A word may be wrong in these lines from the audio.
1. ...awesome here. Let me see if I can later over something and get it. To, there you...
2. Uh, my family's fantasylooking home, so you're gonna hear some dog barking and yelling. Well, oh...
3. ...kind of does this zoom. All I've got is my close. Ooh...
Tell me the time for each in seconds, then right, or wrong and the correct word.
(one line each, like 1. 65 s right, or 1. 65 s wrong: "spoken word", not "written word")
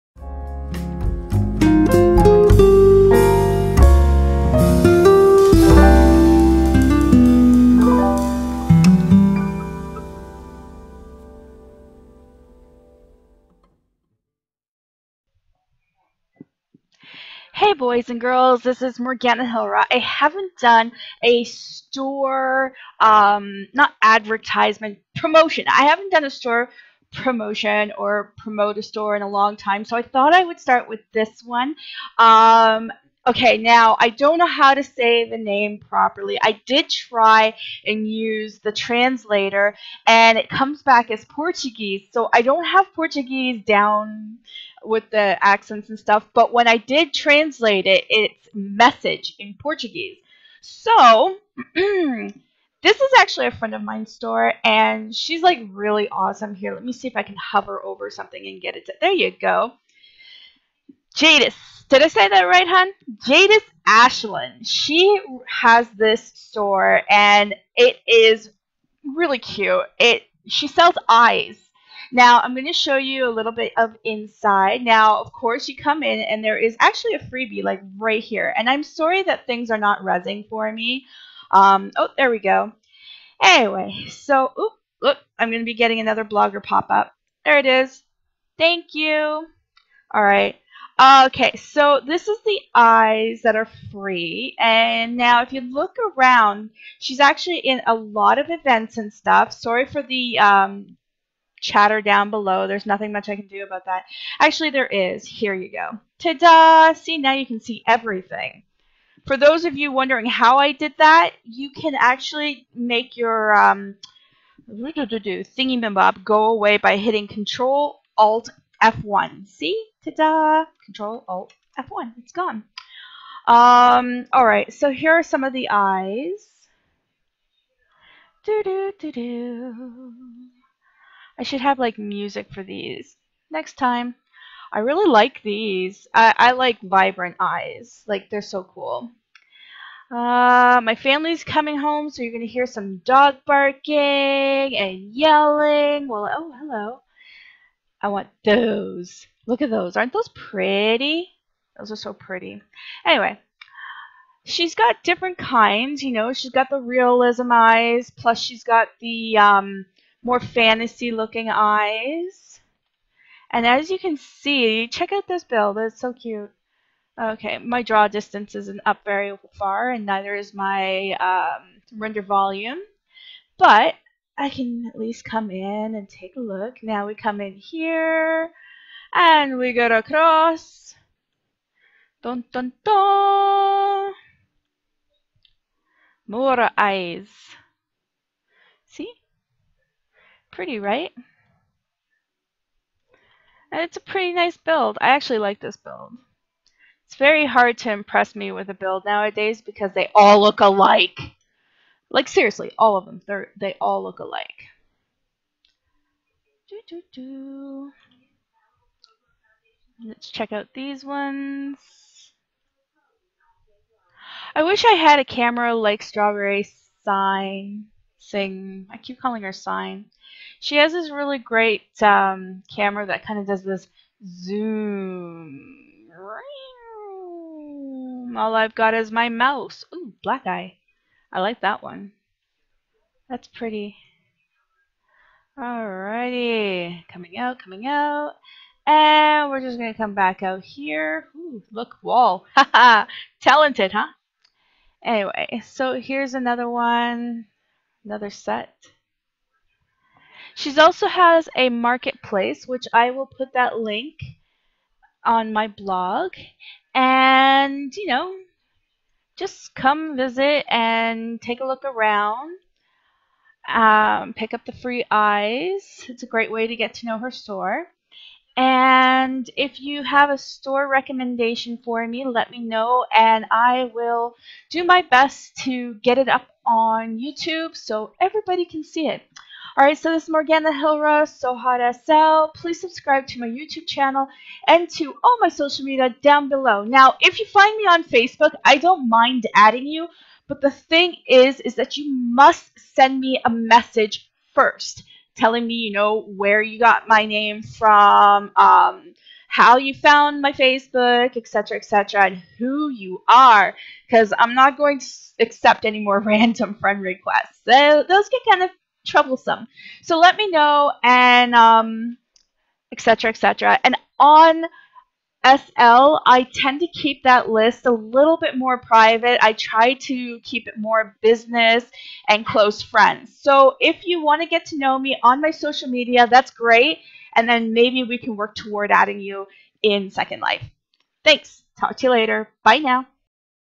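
1. 56 s wrong: "hover", not "later"
2. 140 s wrong: "coming", not "fantasylooking"
3. 223 s wrong: "mouse", not "close".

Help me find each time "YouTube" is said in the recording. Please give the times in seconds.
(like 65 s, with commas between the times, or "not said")
277 s, 283 s.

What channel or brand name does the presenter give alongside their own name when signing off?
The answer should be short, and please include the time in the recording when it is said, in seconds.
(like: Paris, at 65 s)
So Hawt SL, at 281 s.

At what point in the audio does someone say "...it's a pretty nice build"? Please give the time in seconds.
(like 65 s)
193 s.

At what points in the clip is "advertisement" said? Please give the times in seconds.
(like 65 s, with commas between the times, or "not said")
24 s.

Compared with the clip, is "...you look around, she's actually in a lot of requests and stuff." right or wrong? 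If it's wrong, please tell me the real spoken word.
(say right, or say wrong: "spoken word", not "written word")
wrong: "events", not "requests".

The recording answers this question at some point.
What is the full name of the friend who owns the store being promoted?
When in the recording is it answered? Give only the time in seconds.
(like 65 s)
63 s.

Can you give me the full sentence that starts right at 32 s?
Um, Okay, now I don't know how to say the name properly.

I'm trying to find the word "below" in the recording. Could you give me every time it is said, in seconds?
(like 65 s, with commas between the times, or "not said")
102 s, 286 s.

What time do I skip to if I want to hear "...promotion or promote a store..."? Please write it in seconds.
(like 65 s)
27 s.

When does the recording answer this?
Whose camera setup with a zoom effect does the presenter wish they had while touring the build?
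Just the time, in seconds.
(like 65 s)
216 s.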